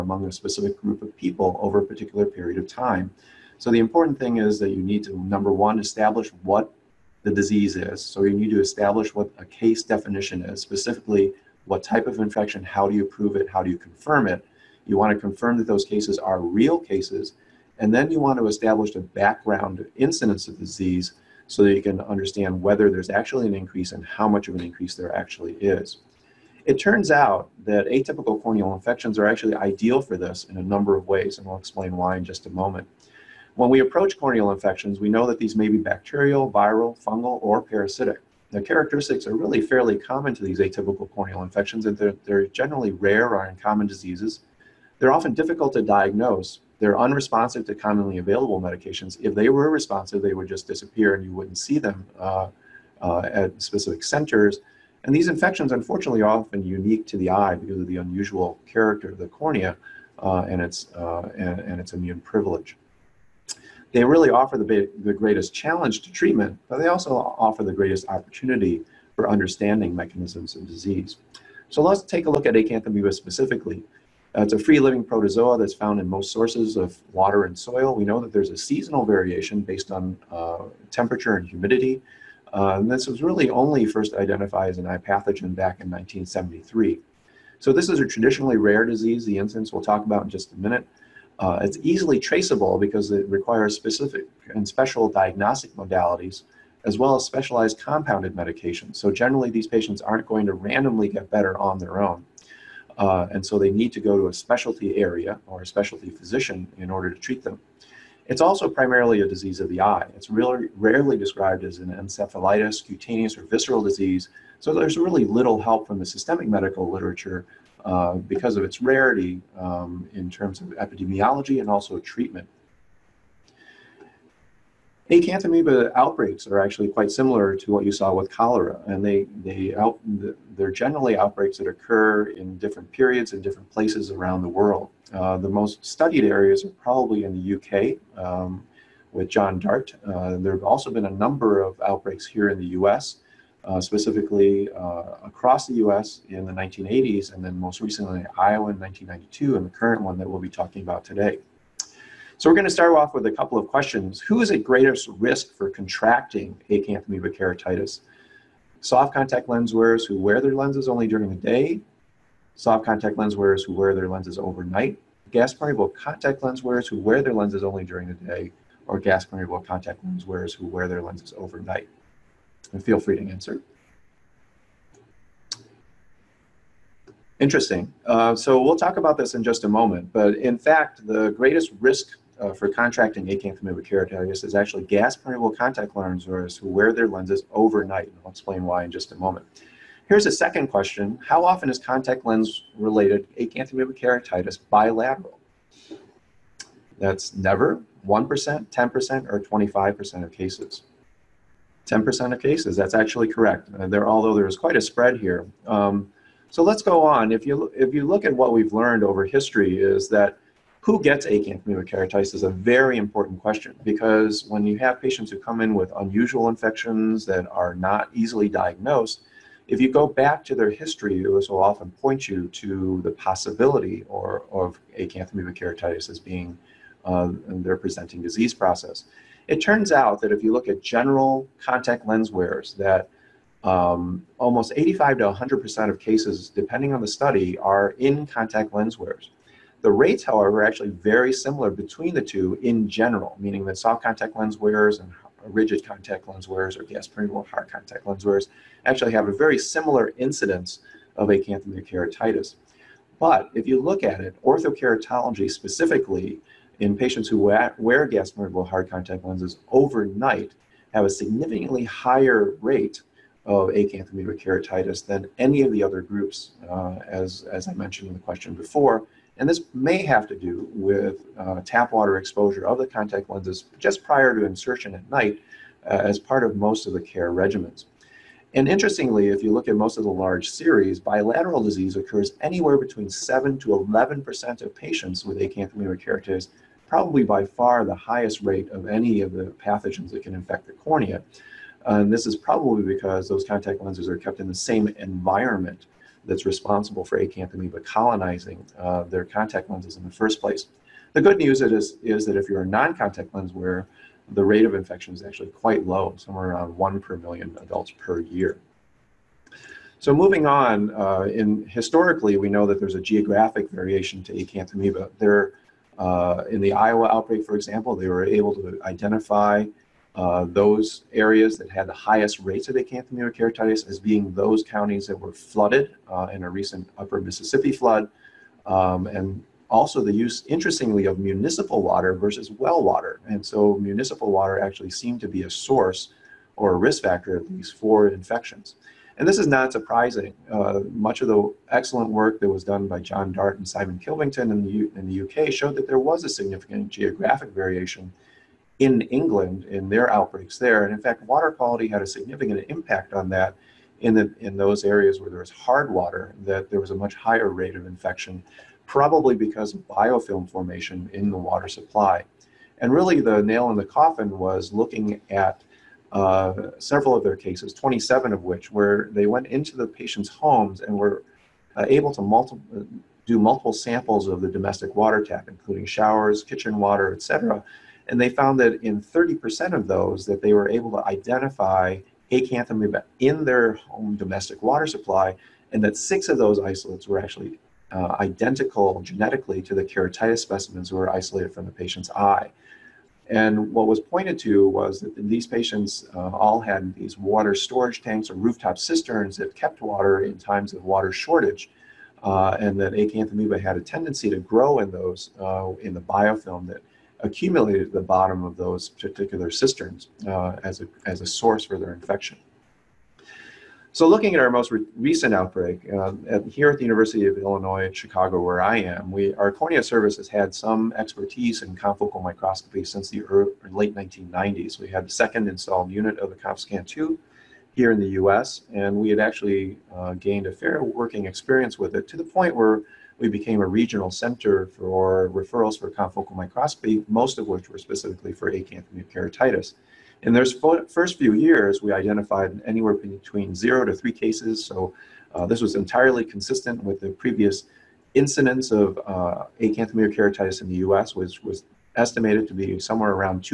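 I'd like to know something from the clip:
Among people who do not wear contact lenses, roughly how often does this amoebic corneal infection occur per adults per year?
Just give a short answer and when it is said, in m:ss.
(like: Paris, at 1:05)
1 per million, at 5:06.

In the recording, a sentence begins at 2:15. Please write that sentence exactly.
Uh, the most studied areas are probably in the UK um, with John Dart.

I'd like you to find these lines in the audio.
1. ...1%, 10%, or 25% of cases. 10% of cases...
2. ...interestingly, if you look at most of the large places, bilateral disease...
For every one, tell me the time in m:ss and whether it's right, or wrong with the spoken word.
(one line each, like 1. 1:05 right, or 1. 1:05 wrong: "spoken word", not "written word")
1. 3:18 right
2. 4:38 wrong: "series", not "places".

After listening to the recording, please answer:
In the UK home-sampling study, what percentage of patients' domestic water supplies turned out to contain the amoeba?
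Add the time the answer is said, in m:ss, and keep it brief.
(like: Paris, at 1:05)
30%, at 6:18.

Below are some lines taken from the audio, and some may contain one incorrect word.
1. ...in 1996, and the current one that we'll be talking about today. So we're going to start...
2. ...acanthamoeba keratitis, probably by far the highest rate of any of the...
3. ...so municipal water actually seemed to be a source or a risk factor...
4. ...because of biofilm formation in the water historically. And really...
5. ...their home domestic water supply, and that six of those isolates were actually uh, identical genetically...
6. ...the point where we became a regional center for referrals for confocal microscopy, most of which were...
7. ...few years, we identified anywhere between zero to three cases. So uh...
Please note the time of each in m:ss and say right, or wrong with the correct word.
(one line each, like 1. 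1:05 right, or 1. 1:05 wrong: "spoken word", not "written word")
1. 2:28 wrong: "1992", not "1996"
2. 4:45 right
3. 5:33 right
4. 5:59 wrong: "supply", not "historically"
5. 6:23 right
6. 7:12 right
7. 7:21 right.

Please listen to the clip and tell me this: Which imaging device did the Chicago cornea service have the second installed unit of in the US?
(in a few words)
ConfoScan 2.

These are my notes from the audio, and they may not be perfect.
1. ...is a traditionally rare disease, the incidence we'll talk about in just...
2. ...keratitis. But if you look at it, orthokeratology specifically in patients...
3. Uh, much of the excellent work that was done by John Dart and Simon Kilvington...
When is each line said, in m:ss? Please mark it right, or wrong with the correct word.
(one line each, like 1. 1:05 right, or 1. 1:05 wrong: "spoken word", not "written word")
1. 1:27 right
2. 4:11 right
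3. 5:40 right.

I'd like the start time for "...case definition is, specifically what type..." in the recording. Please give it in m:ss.
0:09.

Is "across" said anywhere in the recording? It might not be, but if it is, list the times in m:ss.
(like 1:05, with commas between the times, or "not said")
2:25.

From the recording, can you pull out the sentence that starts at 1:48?
It's also primarily a disease of the eye.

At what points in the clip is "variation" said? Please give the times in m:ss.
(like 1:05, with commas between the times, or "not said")
1:19, 5:13, 5:47.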